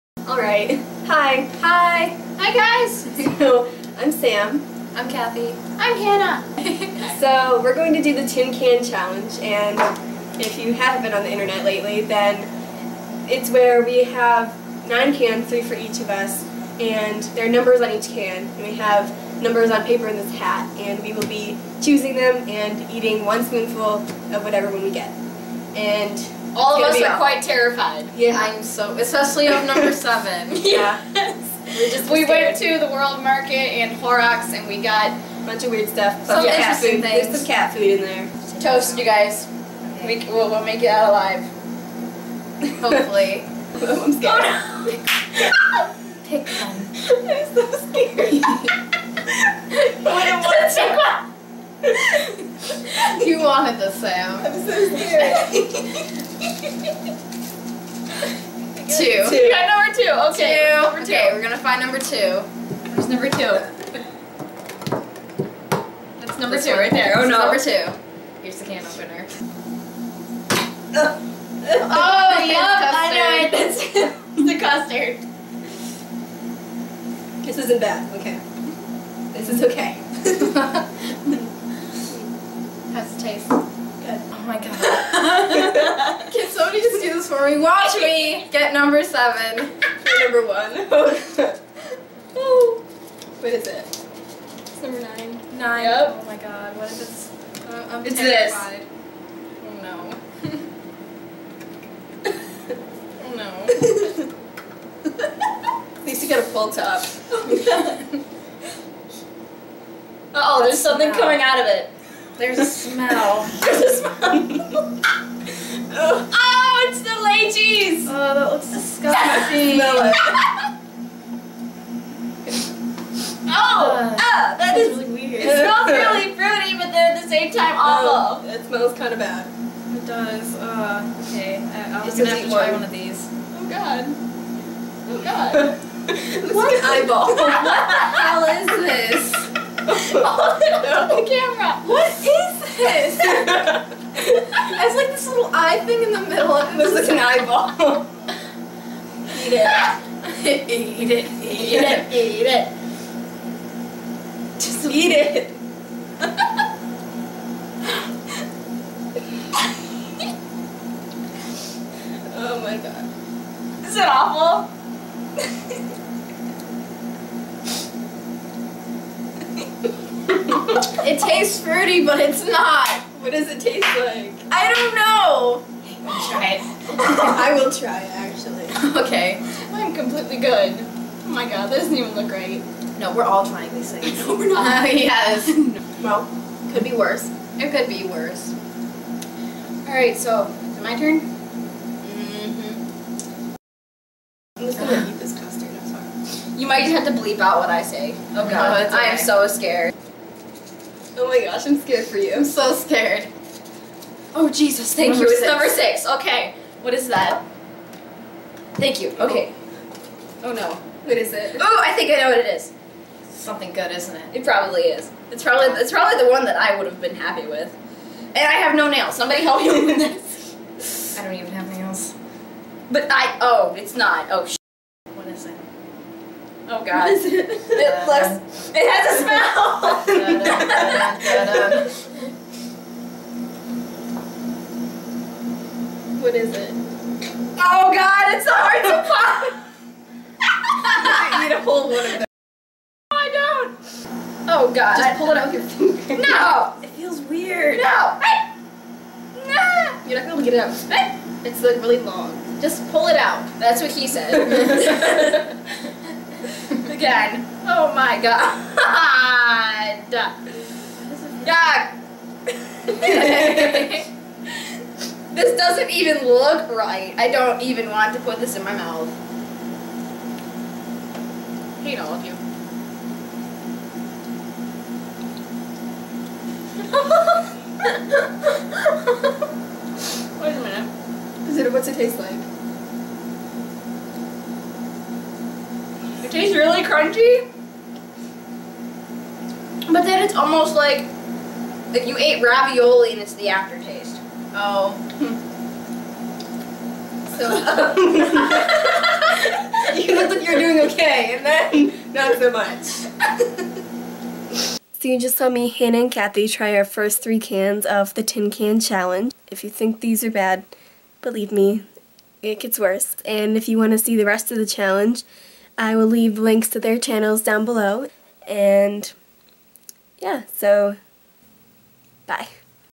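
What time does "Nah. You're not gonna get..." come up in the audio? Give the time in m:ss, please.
4:07.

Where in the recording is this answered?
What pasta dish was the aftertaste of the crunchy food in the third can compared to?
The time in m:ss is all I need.
4:52.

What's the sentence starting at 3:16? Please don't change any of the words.
You might just have to bleep out what I say.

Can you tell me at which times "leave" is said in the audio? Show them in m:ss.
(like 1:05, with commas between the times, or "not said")
5:16.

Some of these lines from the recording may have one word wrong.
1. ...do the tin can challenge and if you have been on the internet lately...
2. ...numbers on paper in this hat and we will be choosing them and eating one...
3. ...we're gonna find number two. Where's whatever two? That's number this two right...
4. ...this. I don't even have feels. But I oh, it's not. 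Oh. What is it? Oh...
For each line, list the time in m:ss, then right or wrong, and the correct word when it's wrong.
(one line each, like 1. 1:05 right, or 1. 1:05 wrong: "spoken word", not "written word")
1. 0:08 right
2. 0:19 right
3. 1:01 wrong: "number", not "whatever"
4. 3:40 wrong: "nails", not "feels".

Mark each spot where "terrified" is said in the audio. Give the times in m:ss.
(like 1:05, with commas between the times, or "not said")
0:27, 1:38.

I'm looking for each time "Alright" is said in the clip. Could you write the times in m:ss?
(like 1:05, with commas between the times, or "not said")
0:00, 3:09.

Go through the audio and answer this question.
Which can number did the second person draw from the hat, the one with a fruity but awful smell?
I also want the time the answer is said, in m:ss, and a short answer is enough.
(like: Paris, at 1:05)
9, at 1:34.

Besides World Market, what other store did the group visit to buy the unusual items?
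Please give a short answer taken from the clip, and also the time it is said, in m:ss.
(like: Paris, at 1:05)
Horrocks, at 0:33.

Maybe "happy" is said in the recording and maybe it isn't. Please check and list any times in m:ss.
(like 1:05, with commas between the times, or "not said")
3:37.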